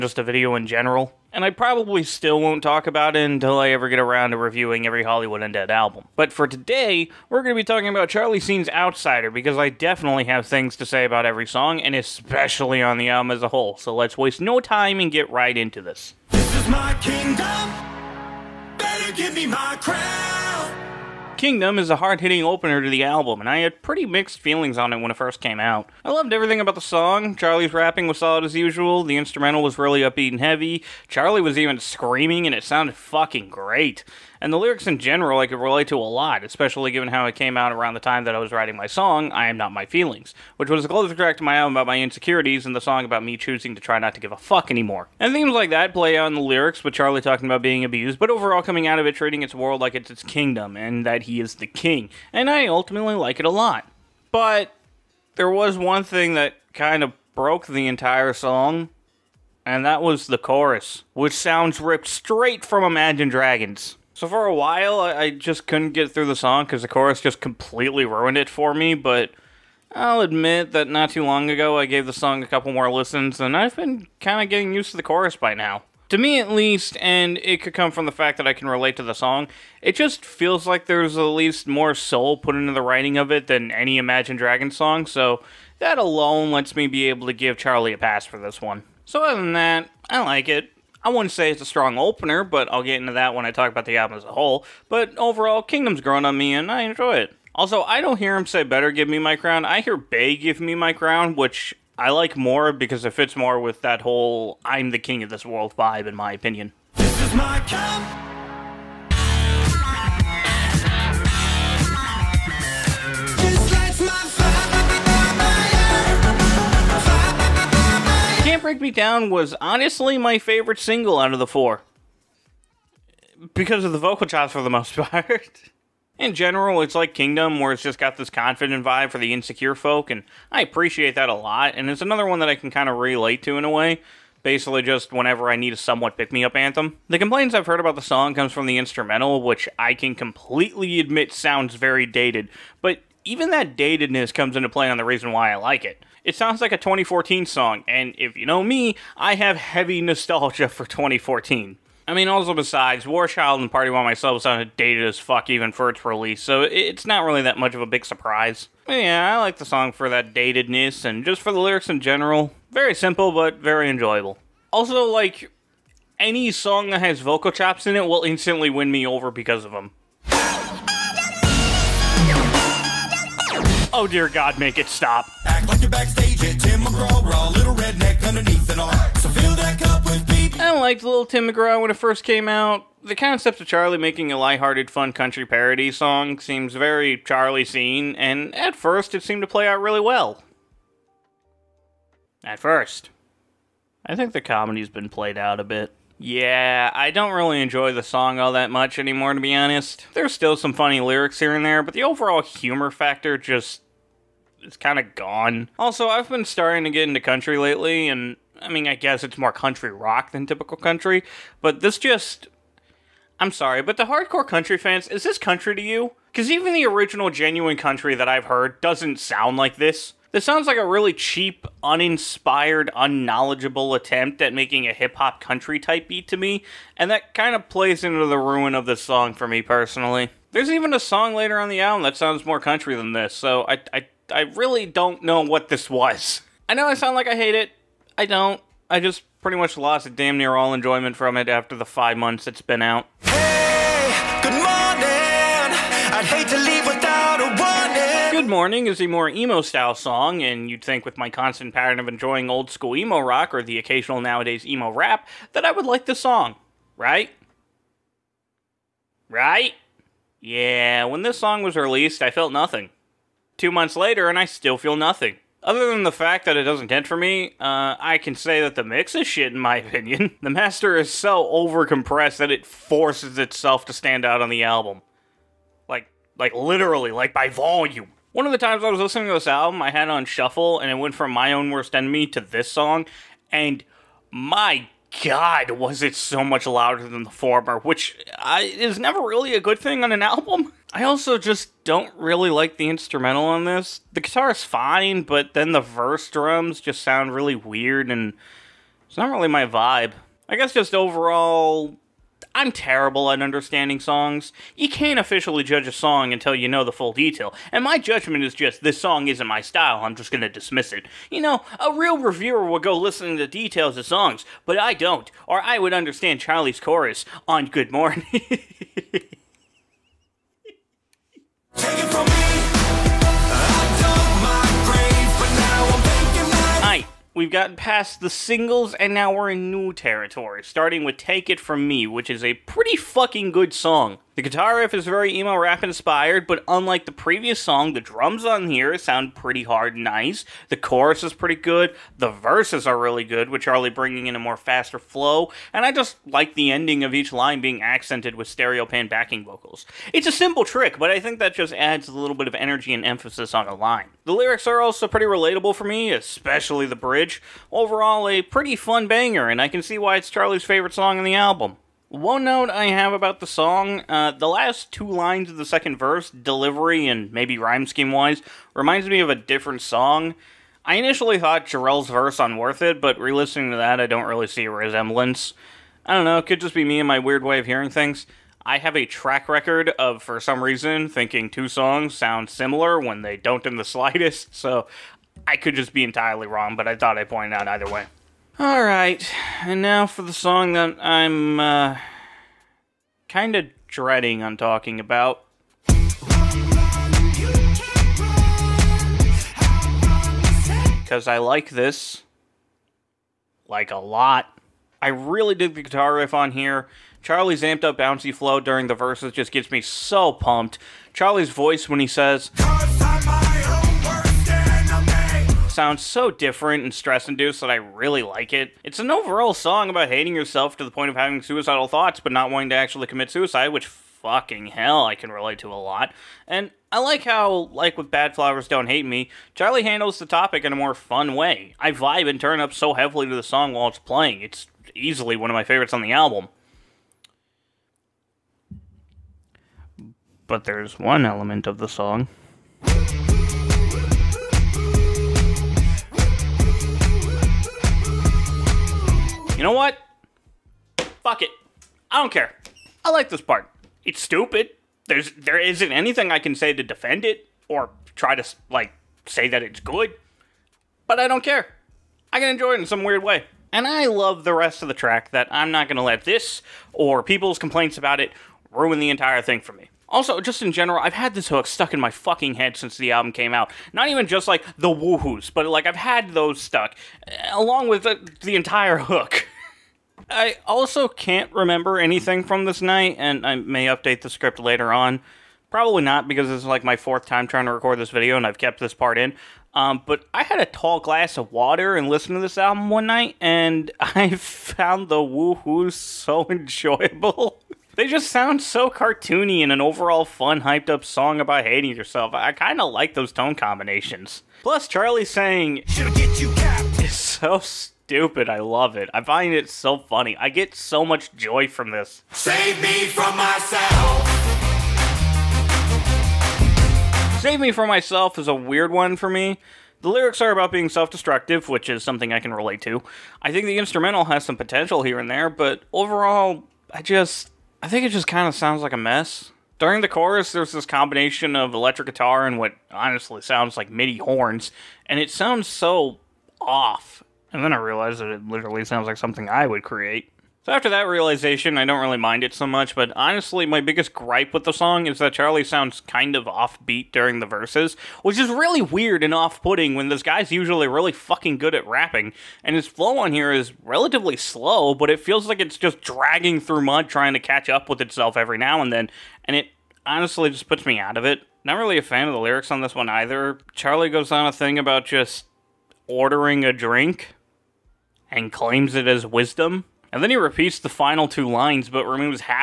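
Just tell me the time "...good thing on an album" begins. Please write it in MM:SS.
04:49.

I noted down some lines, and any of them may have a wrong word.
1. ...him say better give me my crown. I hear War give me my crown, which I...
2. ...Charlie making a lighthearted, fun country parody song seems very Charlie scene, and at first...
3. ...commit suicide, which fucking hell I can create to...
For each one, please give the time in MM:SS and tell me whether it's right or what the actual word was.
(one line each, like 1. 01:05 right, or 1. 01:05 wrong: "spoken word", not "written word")
1. 01:38 wrong: "Bay", not "War"
2. 03:03 right
3. 07:03 wrong: "relate", not "create".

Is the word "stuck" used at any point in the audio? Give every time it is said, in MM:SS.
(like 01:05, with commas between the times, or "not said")
07:51, 07:56.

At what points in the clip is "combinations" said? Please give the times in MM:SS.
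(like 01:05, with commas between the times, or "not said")
08:23, 08:50.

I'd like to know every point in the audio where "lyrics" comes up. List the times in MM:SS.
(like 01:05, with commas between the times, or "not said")
00:34, 00:46, 02:41, 03:20, 05:54, 08:40, 09:22.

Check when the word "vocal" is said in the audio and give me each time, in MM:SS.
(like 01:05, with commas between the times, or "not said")
02:03, 02:47, 05:49.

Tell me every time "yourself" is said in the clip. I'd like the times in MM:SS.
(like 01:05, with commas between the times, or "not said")
07:00, 08:21.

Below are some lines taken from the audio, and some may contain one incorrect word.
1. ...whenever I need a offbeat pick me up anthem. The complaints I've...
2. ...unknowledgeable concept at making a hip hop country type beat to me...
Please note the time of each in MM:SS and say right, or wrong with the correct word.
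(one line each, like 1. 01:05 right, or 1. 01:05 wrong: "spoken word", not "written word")
1. 02:15 wrong: "somewhat", not "offbeat"
2. 03:42 wrong: "attempt", not "concept".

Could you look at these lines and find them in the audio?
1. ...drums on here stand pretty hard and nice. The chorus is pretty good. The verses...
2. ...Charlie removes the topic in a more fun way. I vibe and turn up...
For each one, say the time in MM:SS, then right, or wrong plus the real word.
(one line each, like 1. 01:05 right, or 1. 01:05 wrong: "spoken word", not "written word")
1. 05:38 wrong: "sound", not "stand"
2. 07:09 wrong: "handles", not "removes".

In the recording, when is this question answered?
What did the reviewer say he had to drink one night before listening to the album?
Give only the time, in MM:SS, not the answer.
08:10.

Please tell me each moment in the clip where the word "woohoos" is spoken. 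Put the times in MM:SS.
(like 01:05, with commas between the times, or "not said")
07:54, 08:15.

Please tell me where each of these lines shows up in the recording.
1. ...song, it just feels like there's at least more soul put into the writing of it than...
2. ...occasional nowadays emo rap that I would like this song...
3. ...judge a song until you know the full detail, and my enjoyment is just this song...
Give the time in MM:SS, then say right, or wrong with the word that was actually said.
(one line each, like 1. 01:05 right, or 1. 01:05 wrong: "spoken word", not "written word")
1. 01:19 right
2. 04:13 right
3. 05:05 wrong: "judgment", not "enjoyment".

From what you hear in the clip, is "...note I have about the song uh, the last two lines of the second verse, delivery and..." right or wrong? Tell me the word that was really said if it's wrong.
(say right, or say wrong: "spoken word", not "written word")
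right.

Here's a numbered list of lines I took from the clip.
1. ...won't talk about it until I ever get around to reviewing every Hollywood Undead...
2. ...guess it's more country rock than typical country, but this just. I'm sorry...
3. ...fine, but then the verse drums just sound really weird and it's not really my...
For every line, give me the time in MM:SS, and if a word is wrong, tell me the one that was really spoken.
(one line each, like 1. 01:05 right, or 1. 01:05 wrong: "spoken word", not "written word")
1. 00:02 right
2. 03:28 right
3. 04:54 right.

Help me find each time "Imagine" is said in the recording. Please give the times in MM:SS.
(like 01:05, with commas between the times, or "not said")
01:02, 01:23.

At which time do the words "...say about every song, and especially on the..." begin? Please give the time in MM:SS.
00:10.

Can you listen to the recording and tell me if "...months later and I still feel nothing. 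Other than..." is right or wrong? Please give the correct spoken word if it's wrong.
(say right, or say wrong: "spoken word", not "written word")
right.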